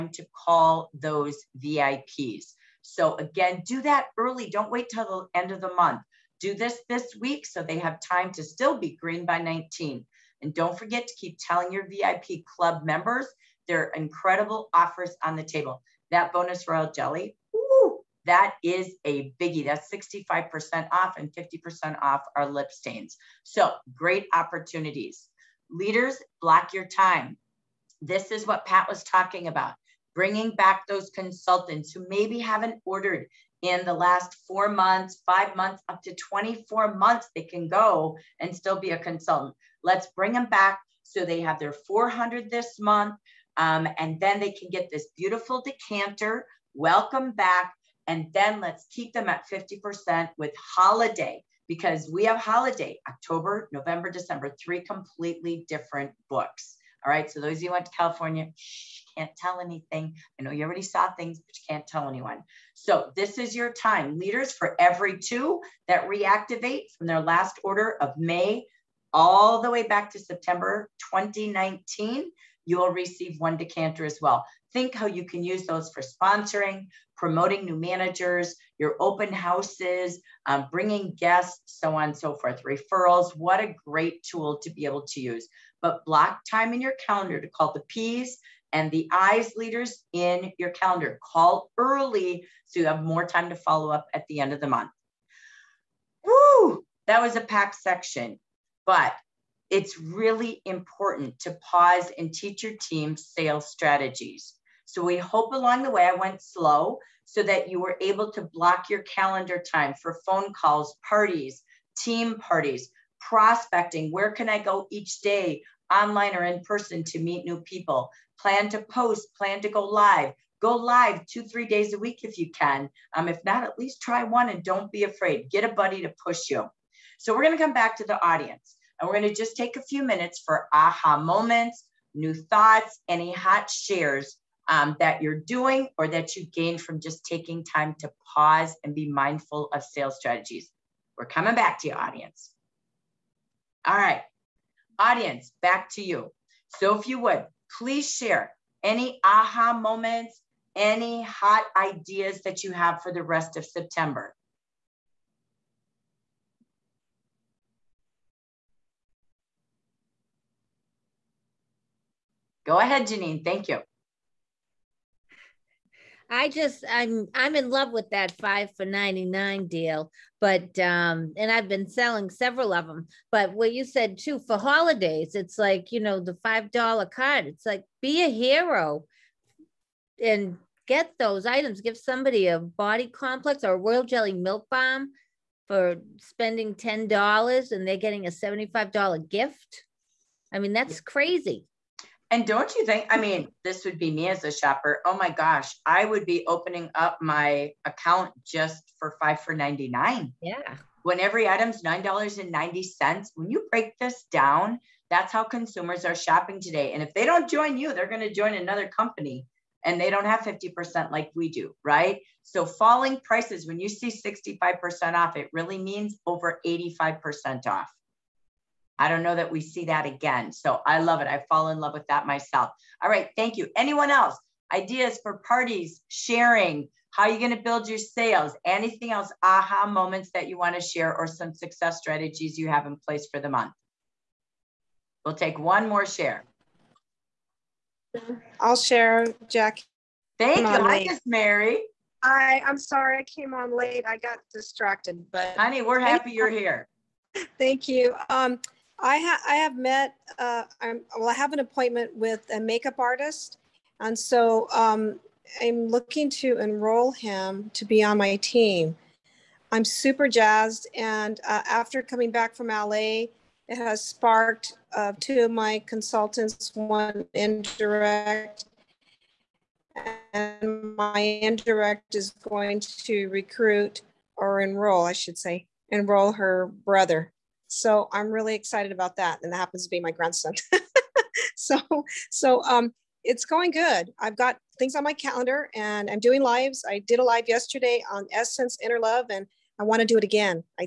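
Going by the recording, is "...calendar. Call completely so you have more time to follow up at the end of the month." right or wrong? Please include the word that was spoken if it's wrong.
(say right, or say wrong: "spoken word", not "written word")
wrong: "early", not "completely".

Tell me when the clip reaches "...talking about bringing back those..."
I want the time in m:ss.
0:29.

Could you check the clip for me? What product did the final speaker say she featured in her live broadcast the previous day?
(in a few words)
Essence Inner Love.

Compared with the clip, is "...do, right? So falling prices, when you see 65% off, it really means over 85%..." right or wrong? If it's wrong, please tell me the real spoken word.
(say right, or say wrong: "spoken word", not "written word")
right.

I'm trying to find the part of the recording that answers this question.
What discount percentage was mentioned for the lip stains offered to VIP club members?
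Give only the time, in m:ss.
0:21.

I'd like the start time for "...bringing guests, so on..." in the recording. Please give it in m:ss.
1:20.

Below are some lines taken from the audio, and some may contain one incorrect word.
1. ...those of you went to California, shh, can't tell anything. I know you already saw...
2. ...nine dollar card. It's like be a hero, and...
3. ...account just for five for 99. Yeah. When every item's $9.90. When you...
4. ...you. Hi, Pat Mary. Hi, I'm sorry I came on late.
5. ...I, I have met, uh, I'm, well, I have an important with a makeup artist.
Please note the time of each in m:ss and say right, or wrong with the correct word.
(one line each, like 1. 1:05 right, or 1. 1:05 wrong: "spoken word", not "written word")
1. 0:57 right
2. 2:56 wrong: "five", not "nine"
3. 3:17 right
4. 4:00 wrong: "Miss", not "Pat"
5. 4:09 wrong: "appointment", not "important".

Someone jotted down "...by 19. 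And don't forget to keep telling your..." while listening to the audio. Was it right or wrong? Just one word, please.
right.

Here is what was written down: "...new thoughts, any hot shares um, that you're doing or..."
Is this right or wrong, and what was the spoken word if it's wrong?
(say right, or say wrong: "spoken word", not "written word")
right.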